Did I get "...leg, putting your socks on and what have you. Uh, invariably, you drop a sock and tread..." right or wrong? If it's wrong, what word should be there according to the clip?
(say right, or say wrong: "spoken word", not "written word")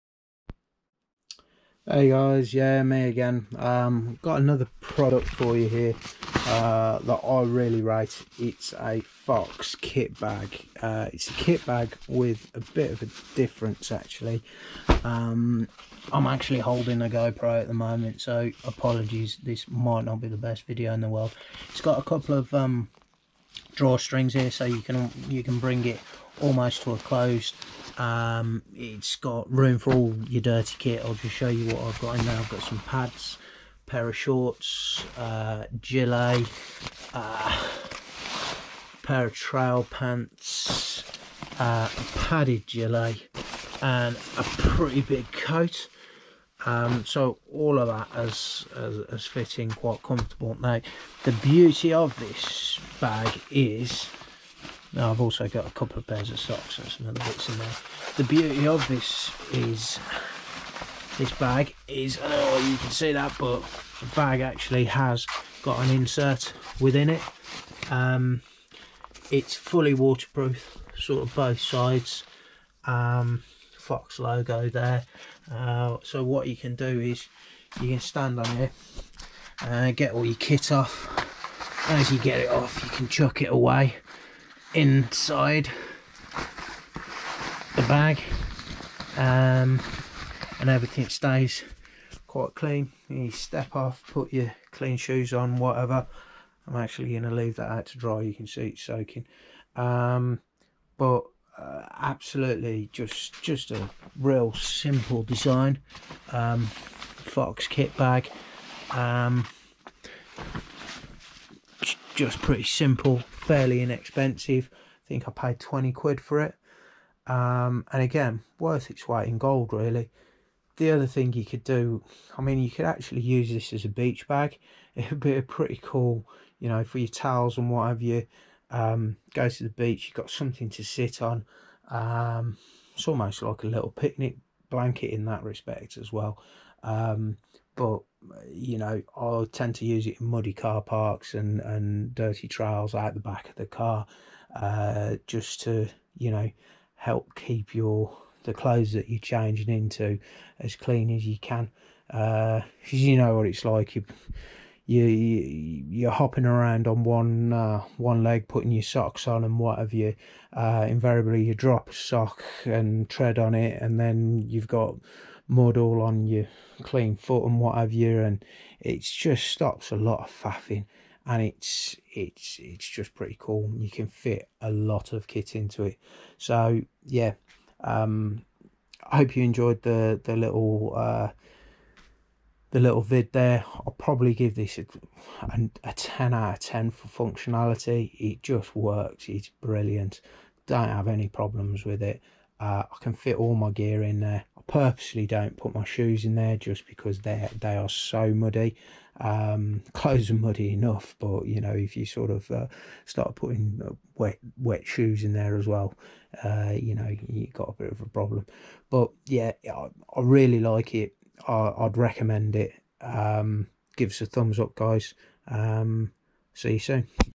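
right.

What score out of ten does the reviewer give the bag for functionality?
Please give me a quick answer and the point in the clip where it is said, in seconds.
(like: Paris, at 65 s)
10, at 185 s.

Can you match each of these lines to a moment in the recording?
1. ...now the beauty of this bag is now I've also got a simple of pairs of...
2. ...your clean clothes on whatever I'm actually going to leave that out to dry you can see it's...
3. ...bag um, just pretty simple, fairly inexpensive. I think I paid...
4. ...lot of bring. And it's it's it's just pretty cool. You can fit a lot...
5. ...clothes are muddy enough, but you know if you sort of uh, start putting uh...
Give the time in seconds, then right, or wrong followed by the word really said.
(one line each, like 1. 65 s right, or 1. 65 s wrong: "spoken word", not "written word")
1. 50 s wrong: "couple", not "simple"
2. 94 s wrong: "shoes", not "clothes"
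3. 107 s right
4. 169 s wrong: "faffing", not "bring"
5. 199 s right.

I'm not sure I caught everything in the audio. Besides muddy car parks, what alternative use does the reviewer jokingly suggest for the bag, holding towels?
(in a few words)
Beach bag.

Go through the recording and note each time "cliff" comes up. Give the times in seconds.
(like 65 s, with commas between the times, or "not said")
not said.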